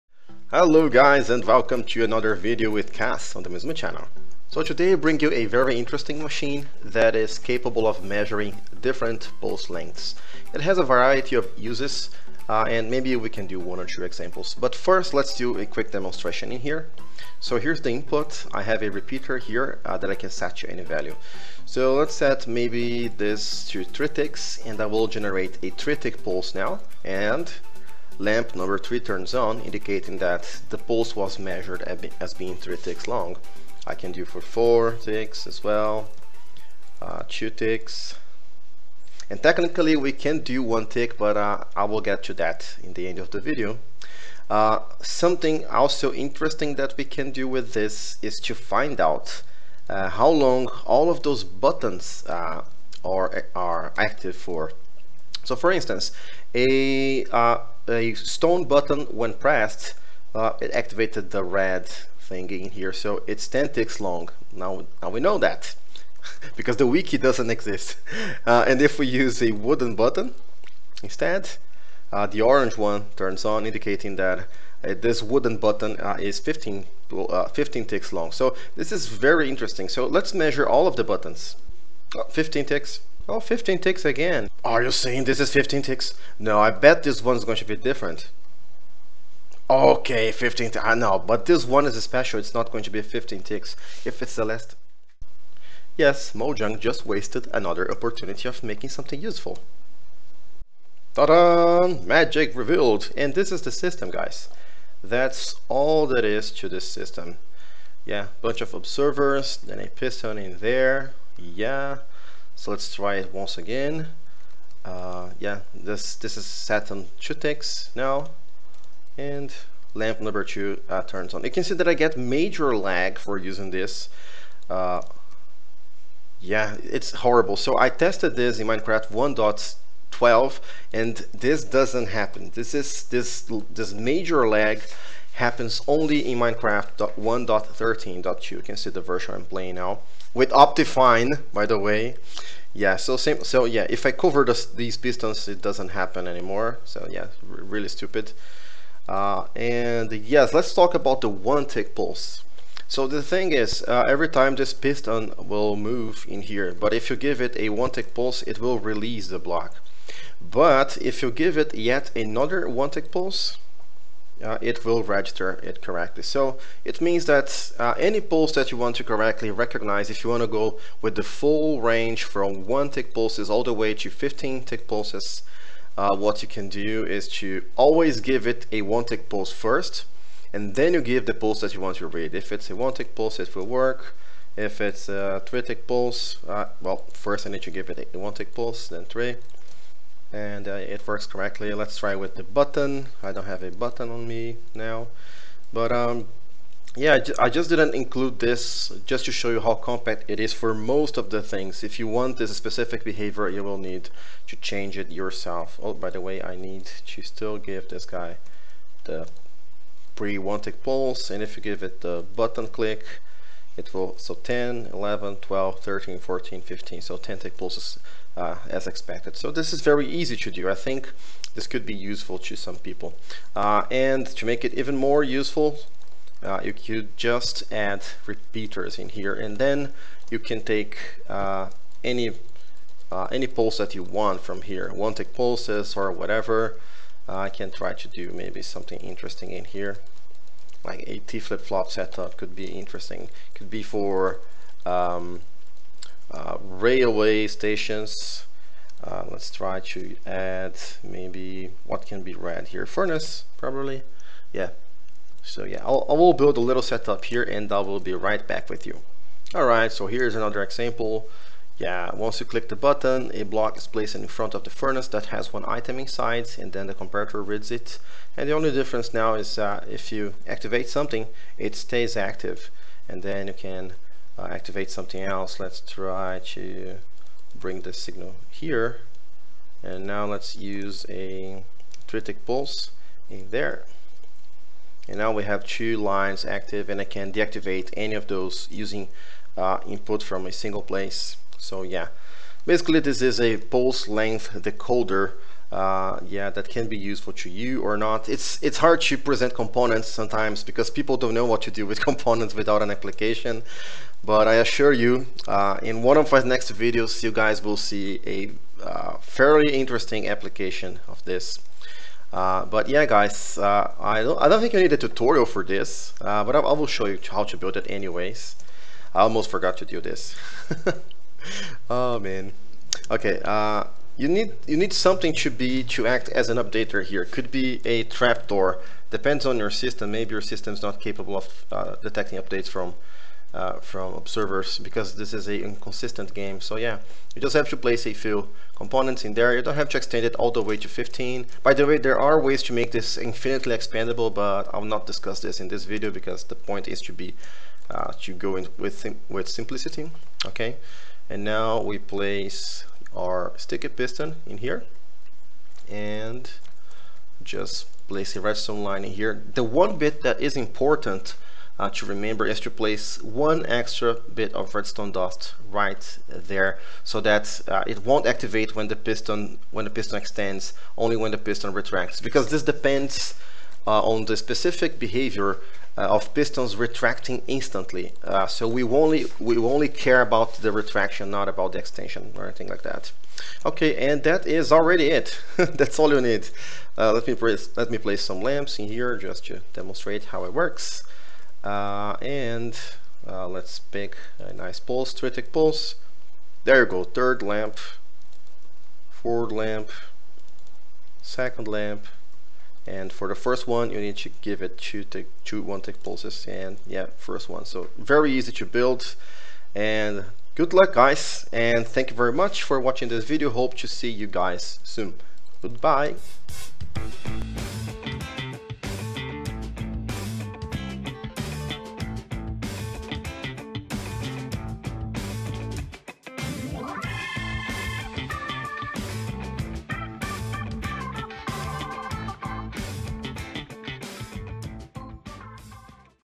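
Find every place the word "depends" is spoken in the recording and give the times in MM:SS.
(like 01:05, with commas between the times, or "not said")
05:29, 06:12.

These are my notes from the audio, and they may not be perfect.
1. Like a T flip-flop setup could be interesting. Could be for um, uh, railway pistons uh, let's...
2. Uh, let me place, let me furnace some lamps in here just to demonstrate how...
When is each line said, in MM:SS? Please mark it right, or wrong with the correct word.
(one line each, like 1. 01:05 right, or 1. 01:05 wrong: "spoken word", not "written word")
1. 04:00 wrong: "stations", not "pistons"
2. 06:26 wrong: "place", not "furnace".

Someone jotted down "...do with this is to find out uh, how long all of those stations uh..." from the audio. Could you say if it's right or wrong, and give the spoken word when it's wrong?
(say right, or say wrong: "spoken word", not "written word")
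wrong: "buttons", not "stations".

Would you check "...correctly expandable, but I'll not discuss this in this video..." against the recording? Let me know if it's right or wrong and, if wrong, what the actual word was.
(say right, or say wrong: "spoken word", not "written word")
wrong: "infinitely", not "correctly".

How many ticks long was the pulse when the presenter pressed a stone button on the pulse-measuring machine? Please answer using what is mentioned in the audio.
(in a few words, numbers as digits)
10 ticks.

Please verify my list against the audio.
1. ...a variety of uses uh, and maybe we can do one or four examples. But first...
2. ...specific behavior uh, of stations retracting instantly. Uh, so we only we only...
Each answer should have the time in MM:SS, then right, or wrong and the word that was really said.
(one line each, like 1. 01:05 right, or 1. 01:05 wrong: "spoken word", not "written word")
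1. 00:10 wrong: "two", not "four"
2. 06:14 wrong: "pistons", not "stations".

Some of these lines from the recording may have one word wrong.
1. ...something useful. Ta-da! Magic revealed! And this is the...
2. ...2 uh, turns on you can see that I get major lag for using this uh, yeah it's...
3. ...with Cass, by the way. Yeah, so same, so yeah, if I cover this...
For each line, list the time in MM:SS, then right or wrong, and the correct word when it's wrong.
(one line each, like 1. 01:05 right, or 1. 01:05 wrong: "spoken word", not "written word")
1. 01:38 right
2. 02:00 right
3. 02:20 wrong: "Optifine", not "Cass".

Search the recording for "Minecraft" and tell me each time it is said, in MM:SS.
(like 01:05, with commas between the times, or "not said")
02:08, 02:16.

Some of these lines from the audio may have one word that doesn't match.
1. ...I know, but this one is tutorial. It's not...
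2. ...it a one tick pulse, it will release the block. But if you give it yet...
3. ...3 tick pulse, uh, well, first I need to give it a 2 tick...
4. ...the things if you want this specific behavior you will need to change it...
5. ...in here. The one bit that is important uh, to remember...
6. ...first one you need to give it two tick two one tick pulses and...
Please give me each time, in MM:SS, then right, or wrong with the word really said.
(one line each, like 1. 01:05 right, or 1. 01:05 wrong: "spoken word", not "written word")
1. 01:30 wrong: "special", not "tutorial"
2. 02:37 right
3. 03:05 wrong: "1", not "2"
4. 03:21 right
5. 05:59 right
6. 06:43 right.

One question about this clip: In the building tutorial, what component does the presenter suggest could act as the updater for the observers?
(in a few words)
A trapdoor.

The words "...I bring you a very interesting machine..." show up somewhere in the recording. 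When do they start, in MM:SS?
00:04.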